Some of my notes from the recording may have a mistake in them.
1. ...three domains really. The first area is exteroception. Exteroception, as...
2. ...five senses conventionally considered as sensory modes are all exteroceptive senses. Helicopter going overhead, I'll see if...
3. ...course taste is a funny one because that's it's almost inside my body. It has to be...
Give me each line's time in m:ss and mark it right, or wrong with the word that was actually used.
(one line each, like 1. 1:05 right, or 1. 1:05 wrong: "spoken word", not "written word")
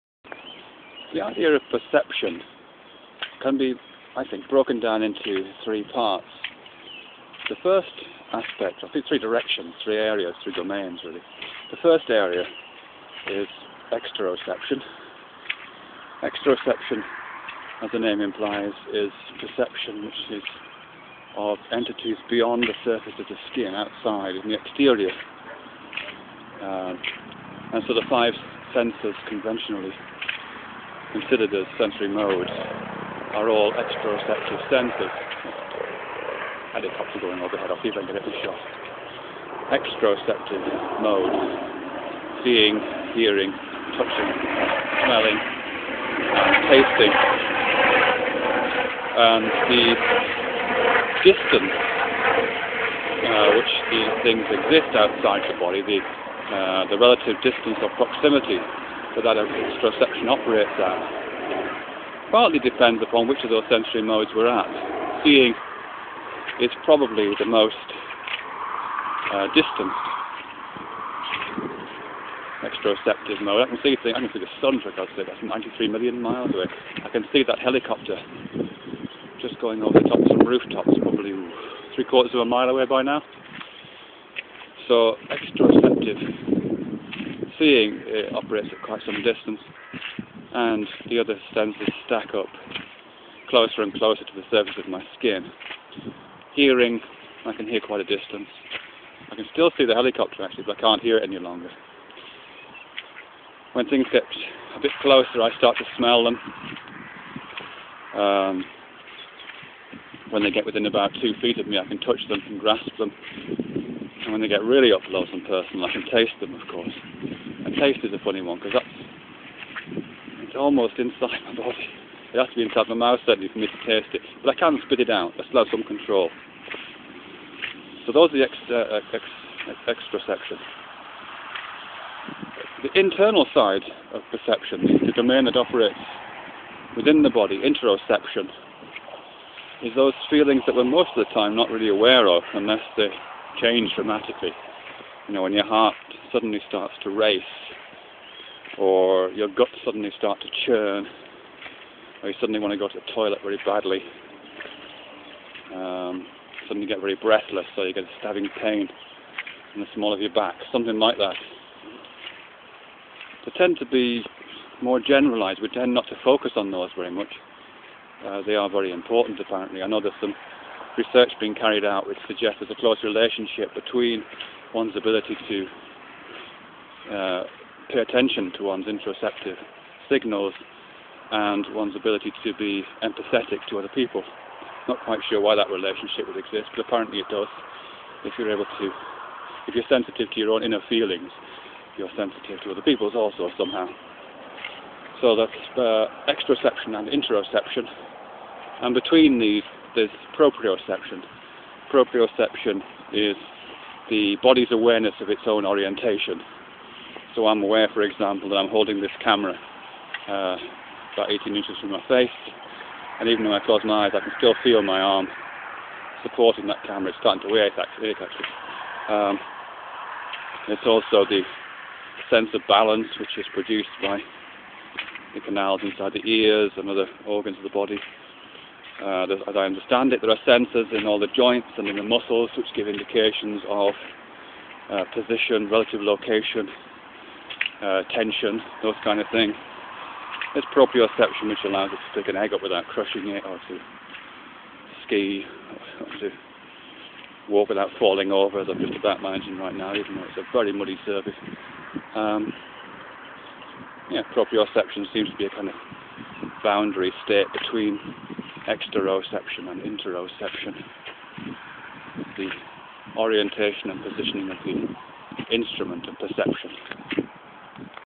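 1. 0:10 right
2. 0:28 right
3. 1:56 right.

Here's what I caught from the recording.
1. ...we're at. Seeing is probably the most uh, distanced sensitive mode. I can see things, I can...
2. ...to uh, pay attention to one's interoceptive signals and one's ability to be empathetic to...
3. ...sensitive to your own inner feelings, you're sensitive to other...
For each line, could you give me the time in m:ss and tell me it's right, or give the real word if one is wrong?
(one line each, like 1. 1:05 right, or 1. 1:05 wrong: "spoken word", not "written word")
1. 1:04 wrong: "exteroceptive", not "sensitive"
2. 2:55 right
3. 3:09 right.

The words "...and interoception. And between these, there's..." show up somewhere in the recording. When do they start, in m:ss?
3:16.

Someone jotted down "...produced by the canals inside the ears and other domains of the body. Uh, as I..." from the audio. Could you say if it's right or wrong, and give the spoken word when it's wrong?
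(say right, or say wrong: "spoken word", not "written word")
wrong: "organs", not "domains".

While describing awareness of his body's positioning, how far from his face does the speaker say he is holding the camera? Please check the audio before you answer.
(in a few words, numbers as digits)
about 18 inches.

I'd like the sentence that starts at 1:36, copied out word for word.
Hearing, I can hear quite a distance.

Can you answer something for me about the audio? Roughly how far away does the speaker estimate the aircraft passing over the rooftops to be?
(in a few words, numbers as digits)
three quarters of a mile.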